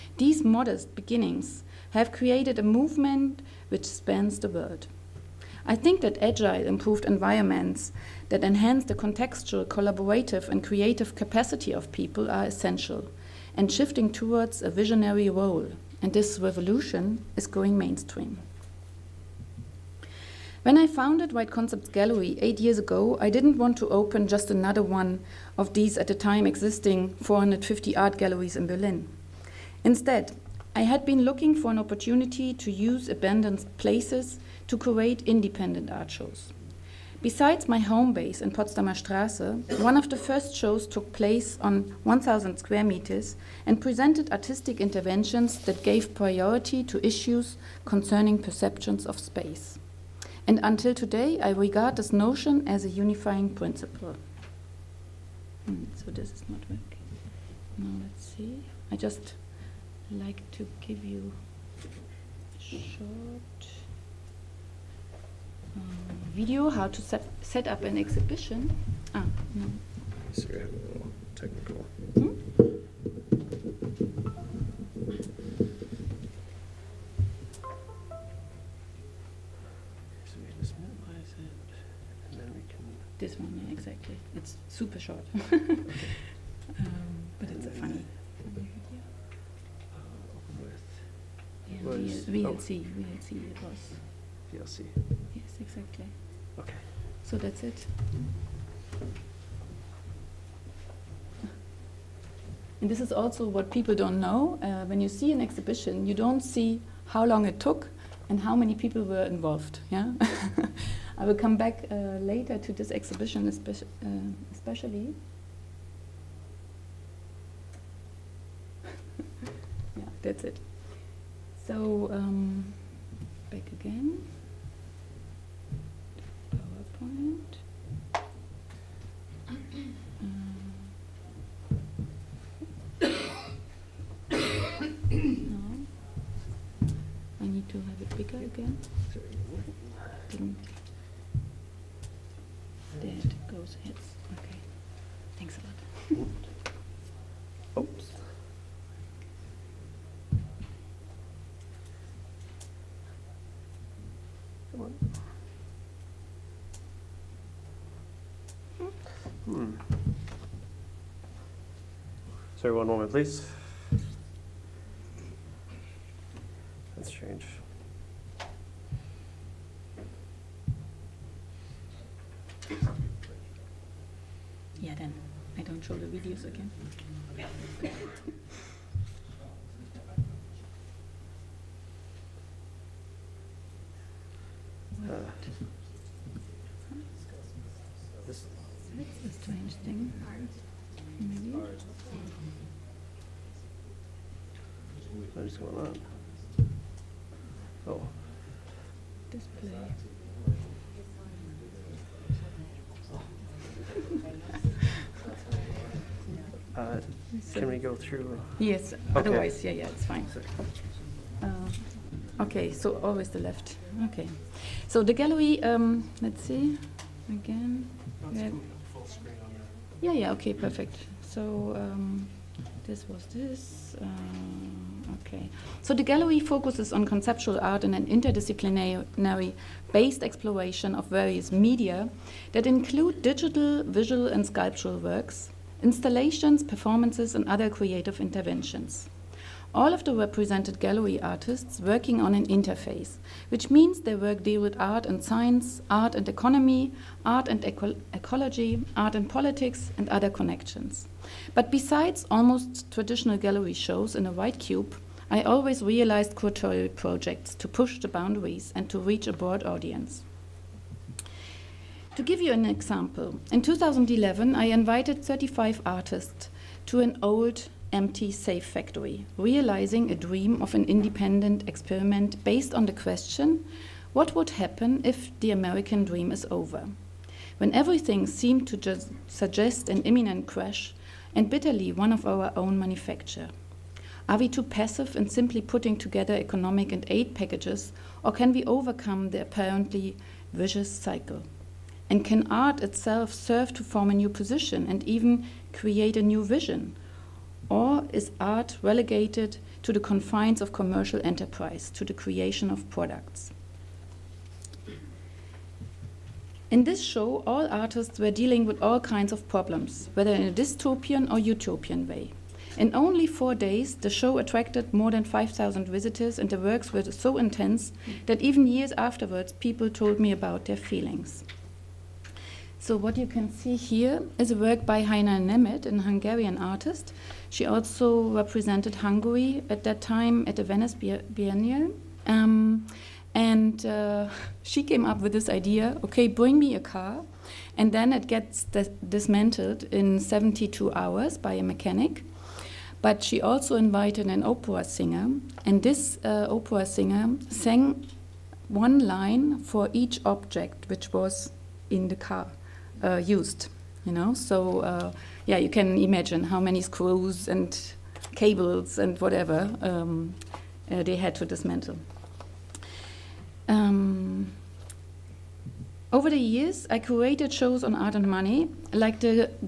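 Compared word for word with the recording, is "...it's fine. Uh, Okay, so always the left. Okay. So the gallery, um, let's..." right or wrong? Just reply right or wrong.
right.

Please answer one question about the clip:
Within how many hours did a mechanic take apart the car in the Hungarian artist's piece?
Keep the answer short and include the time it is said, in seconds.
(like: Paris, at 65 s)
72 hours, at 340 s.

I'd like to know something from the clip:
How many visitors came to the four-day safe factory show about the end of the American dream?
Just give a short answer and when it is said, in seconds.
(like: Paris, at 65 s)
more than 5,000, at 314 s.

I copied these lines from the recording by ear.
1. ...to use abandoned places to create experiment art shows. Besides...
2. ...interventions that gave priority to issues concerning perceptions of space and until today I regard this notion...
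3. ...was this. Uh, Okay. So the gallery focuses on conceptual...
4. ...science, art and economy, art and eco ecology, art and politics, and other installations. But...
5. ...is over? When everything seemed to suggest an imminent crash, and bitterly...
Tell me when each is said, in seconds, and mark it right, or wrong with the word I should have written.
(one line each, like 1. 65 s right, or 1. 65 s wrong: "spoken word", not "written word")
1. 32 s wrong: "independent", not "experiment"
2. 44 s right
3. 223 s right
4. 245 s wrong: "connections", not "installations"
5. 276 s right.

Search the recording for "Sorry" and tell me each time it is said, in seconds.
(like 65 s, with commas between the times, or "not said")
70 s, 162 s.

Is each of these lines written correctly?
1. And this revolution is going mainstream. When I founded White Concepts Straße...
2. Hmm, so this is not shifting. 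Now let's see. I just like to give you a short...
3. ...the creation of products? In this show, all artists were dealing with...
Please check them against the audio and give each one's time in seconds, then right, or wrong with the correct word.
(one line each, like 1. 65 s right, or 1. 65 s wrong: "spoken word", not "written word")
1. 16 s wrong: "Gallery", not "Straße"
2. 55 s wrong: "working", not "shifting"
3. 302 s right.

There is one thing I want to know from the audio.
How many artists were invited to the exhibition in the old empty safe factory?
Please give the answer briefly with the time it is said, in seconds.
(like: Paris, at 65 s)
35, at 265 s.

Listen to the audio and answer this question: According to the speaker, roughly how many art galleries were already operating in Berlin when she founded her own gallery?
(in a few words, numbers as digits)
450.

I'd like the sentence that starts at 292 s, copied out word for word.
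And can art itself serve to form a new position and even create a new vision?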